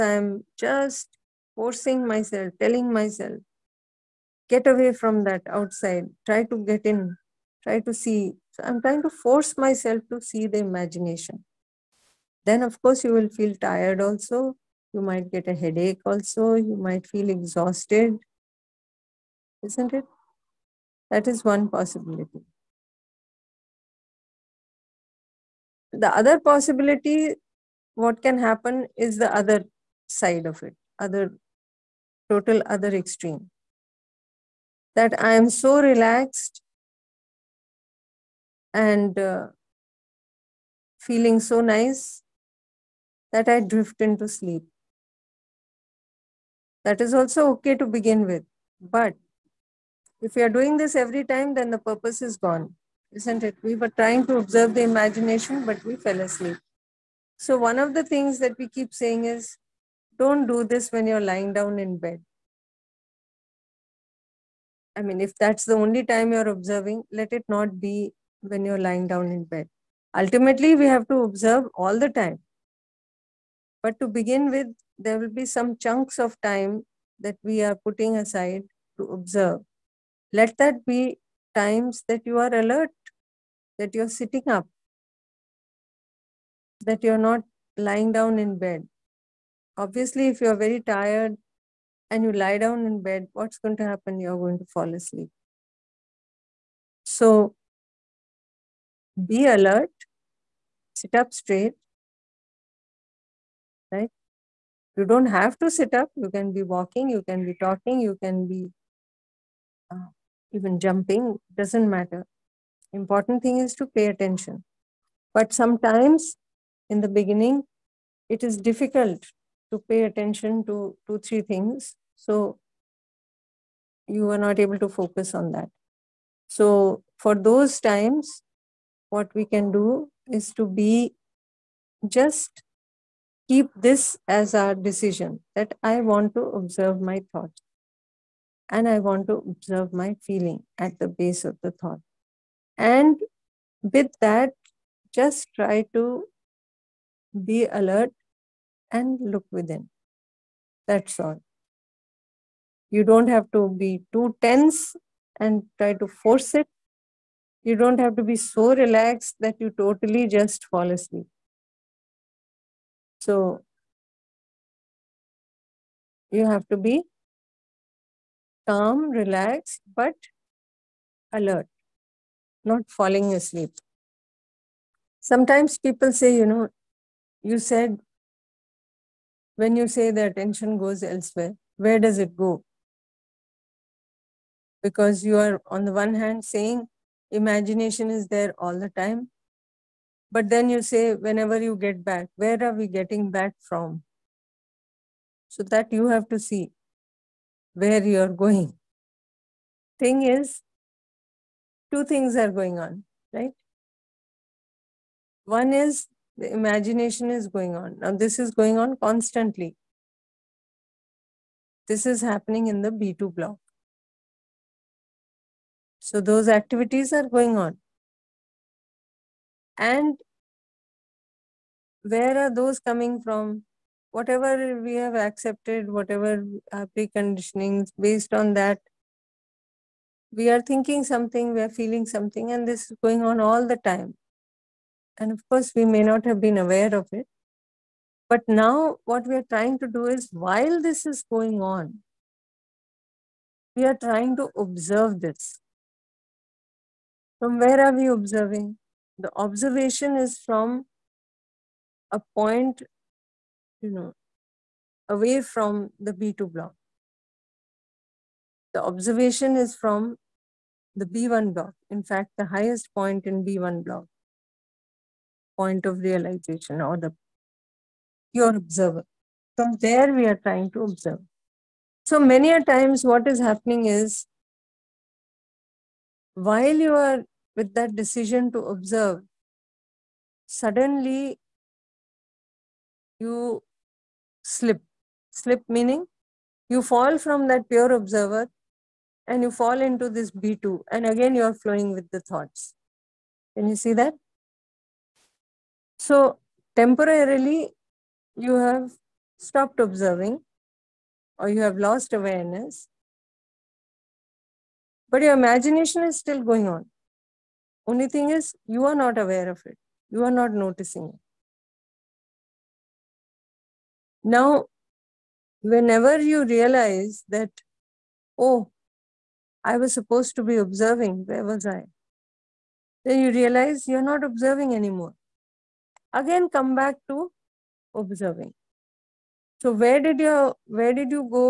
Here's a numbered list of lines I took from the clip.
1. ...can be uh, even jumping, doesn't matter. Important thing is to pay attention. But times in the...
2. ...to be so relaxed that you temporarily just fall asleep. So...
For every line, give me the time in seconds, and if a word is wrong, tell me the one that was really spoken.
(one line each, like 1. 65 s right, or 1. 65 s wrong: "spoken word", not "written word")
1. 108 s wrong: "sometimes", not "times"
2. 158 s wrong: "totally", not "temporarily".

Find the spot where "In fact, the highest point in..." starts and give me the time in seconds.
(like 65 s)
261 s.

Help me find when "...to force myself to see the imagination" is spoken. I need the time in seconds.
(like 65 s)
9 s.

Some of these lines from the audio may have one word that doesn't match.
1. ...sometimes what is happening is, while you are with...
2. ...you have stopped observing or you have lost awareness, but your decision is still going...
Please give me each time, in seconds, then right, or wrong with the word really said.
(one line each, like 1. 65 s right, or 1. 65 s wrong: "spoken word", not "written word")
1. 272 s wrong: "times", not "sometimes"
2. 298 s wrong: "imagination", not "decision".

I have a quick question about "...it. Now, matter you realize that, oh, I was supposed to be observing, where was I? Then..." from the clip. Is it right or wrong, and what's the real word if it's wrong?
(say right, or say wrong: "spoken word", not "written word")
wrong: "whenever", not "matter".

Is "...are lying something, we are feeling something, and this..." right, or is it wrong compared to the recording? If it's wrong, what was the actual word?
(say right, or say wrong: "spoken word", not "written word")
wrong: "thinking", not "lying".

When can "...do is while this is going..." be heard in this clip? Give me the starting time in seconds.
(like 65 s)
239 s.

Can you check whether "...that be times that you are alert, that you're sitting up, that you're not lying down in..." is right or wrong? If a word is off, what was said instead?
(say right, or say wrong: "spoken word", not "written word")
right.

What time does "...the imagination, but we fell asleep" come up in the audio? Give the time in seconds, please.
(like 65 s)
54 s.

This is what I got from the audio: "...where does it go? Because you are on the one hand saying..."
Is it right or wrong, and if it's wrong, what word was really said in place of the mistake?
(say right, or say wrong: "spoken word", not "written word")
right.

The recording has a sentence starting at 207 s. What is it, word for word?
Now, this is going on constantly.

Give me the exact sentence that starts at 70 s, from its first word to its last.
Ultimately, we have to observe all the time.